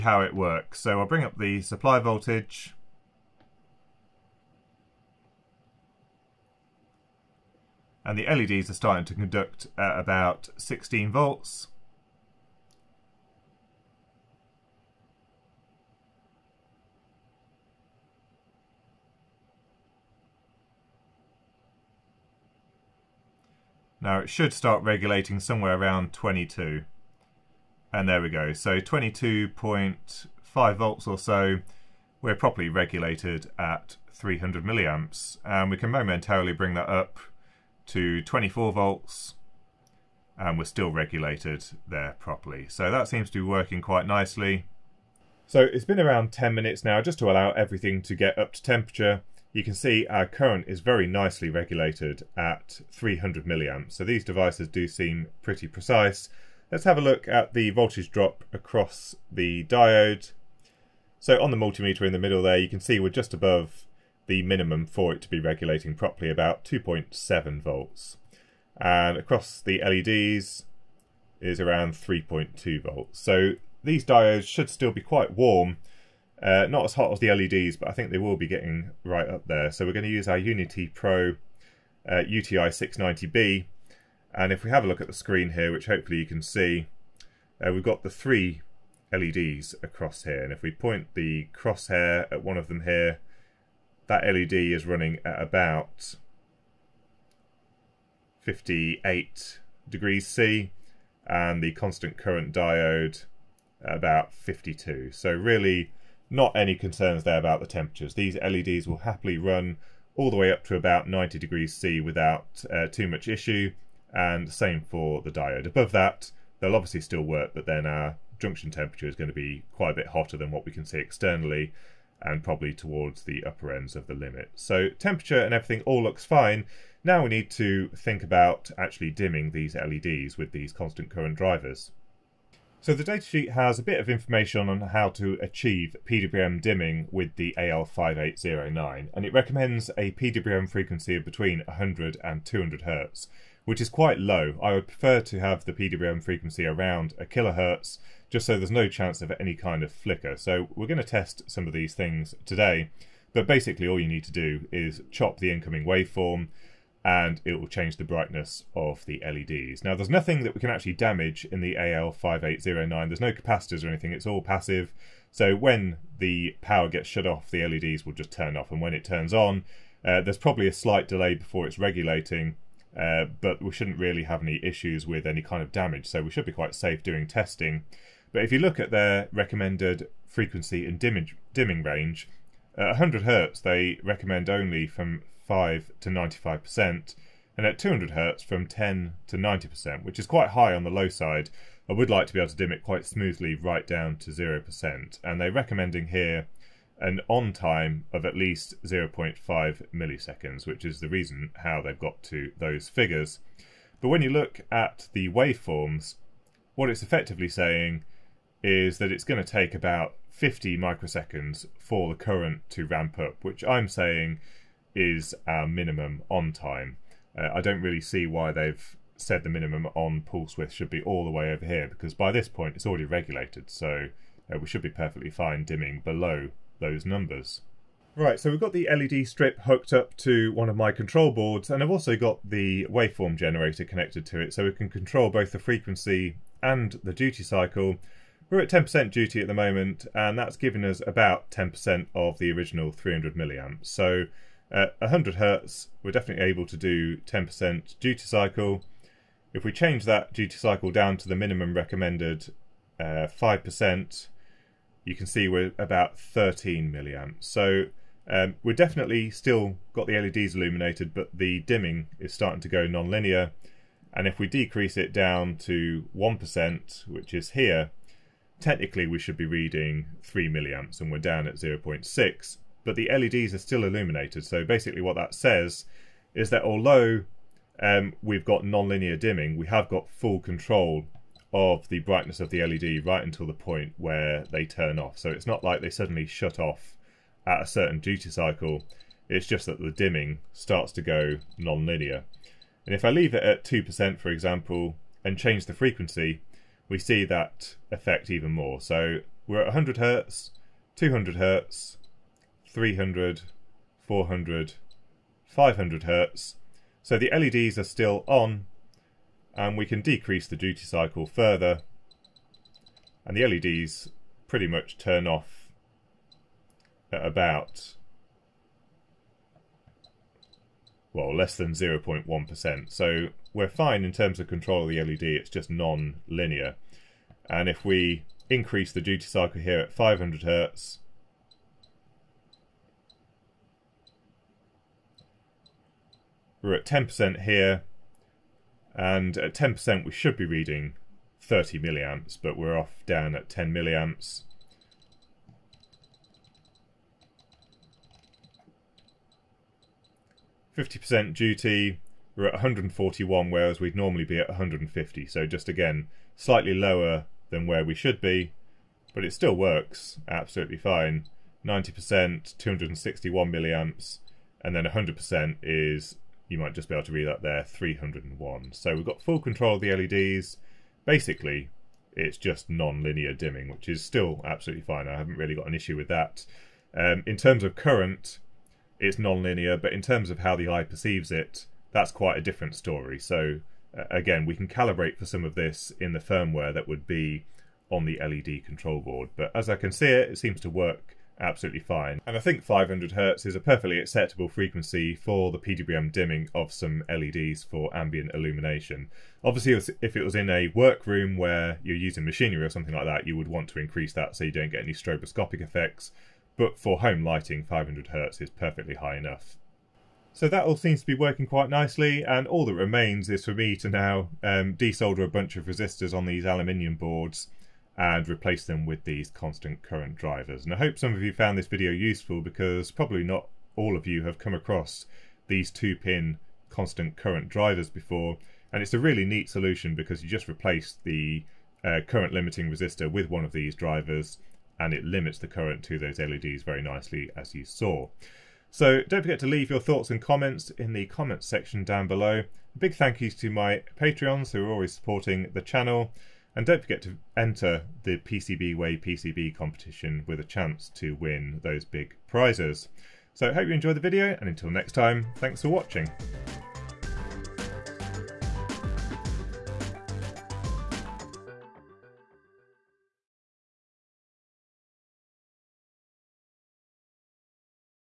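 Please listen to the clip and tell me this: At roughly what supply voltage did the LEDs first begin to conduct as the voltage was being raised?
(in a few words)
16 volts.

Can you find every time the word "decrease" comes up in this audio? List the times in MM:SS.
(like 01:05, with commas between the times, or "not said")
04:24, 05:10.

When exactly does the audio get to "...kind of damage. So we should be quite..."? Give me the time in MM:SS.
02:55.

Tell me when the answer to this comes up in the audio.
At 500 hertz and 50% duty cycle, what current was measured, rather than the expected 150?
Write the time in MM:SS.
05:52.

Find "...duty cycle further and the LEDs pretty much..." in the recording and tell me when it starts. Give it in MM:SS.
05:10.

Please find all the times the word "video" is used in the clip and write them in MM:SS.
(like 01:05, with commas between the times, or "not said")
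07:01, 07:34.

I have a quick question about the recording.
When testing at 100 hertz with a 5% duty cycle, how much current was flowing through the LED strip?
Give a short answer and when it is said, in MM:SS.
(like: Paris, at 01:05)
13 milliamps, at 04:16.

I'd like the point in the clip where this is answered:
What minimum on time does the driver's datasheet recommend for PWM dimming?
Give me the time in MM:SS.
03:18.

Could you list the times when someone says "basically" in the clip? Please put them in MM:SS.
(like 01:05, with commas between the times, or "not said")
02:33, 04:34, 06:11.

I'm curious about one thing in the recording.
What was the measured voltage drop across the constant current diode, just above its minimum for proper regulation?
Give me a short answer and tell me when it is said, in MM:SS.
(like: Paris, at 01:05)
2.7 volts, at 01:06.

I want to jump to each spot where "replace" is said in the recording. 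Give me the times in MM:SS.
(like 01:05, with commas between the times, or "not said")
06:58, 07:10.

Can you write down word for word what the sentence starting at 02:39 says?
Now, there's nothing that we can actually damage in the AL5809.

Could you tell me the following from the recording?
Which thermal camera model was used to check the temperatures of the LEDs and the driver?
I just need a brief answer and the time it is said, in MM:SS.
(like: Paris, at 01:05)
UTI 690B, at 01:22.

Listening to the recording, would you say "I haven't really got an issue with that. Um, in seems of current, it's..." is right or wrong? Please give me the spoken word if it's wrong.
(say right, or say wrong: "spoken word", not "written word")
wrong: "terms", not "seems".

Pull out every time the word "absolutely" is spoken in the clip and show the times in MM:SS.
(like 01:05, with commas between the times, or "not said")
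06:00, 06:14, 06:31.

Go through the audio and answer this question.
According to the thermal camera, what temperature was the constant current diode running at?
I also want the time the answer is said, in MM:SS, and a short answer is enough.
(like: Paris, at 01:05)
52 degrees C, at 01:43.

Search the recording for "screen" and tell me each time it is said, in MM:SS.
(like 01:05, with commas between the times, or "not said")
01:25.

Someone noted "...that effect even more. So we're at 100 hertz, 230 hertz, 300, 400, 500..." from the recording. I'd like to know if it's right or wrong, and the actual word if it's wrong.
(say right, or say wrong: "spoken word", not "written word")
wrong: "200", not "230".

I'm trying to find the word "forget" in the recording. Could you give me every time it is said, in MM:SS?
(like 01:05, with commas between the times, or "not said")
07:19, 07:26.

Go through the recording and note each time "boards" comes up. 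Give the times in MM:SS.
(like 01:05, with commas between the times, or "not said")
03:51, 06:29, 06:56.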